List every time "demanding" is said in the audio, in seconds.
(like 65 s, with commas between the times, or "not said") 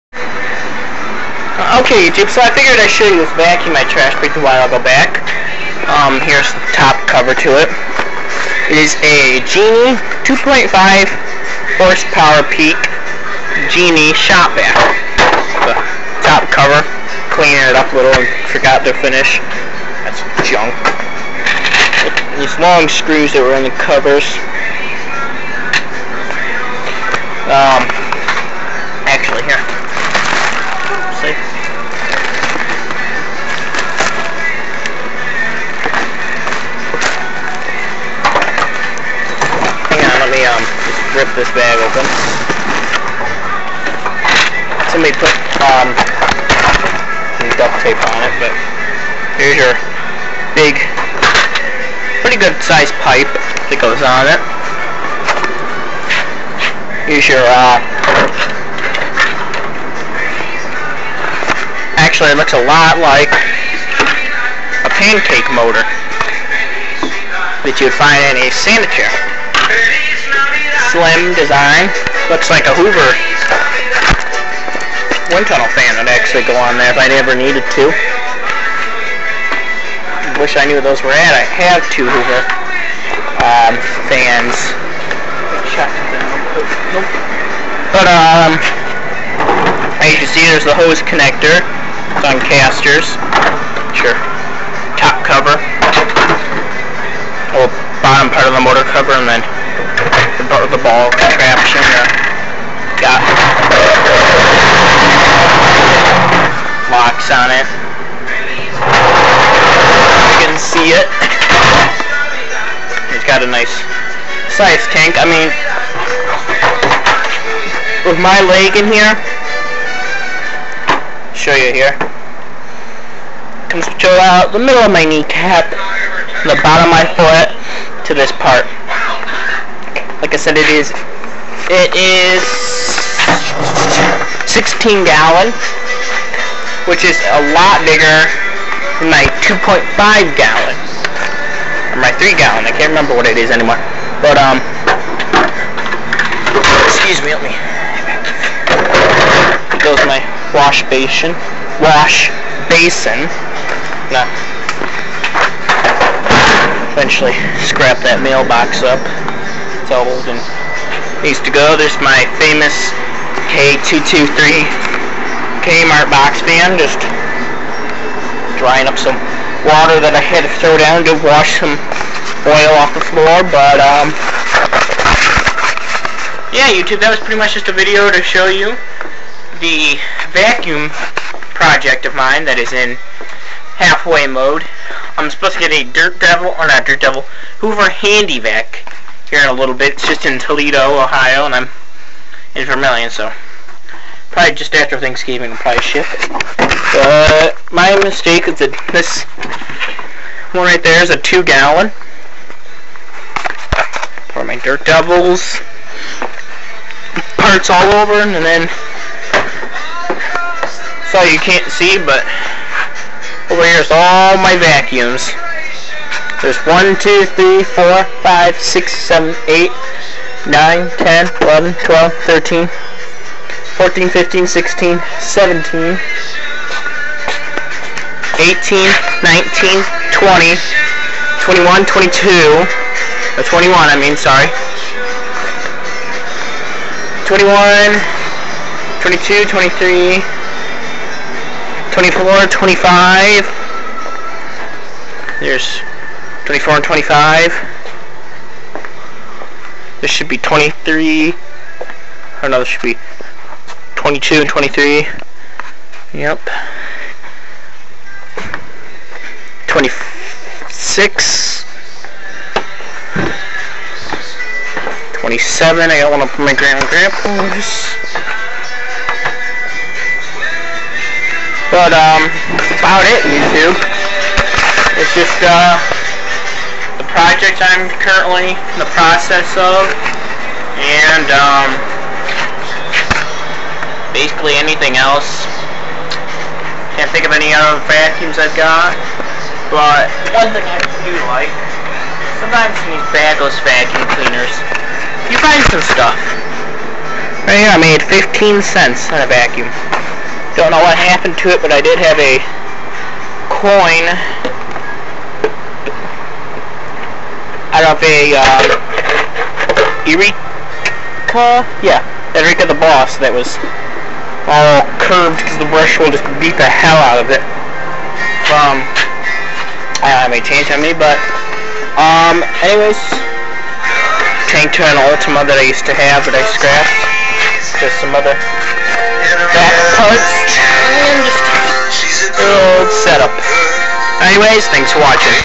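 not said.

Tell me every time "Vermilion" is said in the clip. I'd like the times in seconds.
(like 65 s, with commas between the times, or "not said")
192 s.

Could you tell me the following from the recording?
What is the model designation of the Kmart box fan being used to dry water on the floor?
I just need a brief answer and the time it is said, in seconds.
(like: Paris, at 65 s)
K223, at 163 s.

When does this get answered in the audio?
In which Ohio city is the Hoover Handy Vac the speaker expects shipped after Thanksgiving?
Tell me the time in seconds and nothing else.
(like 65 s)
190 s.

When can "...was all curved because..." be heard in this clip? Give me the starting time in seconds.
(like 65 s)
313 s.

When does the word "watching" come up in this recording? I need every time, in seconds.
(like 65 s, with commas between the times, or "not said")
335 s.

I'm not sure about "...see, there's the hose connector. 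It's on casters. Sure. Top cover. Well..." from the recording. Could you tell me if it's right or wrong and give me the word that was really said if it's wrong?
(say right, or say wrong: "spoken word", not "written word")
right.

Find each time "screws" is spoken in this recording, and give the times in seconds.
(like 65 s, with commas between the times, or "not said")
22 s.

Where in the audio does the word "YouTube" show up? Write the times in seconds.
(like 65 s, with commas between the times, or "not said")
2 s, 176 s, 273 s.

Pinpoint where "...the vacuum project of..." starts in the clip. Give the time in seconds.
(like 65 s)
179 s.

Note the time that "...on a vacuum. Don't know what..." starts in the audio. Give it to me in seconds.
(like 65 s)
299 s.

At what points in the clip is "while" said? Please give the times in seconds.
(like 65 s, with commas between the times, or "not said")
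4 s.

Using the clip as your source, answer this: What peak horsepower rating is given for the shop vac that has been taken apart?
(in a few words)
2.5 horsepower.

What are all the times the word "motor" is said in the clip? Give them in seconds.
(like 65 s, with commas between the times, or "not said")
65 s, 98 s.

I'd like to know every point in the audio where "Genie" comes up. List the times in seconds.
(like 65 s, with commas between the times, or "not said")
9 s, 13 s.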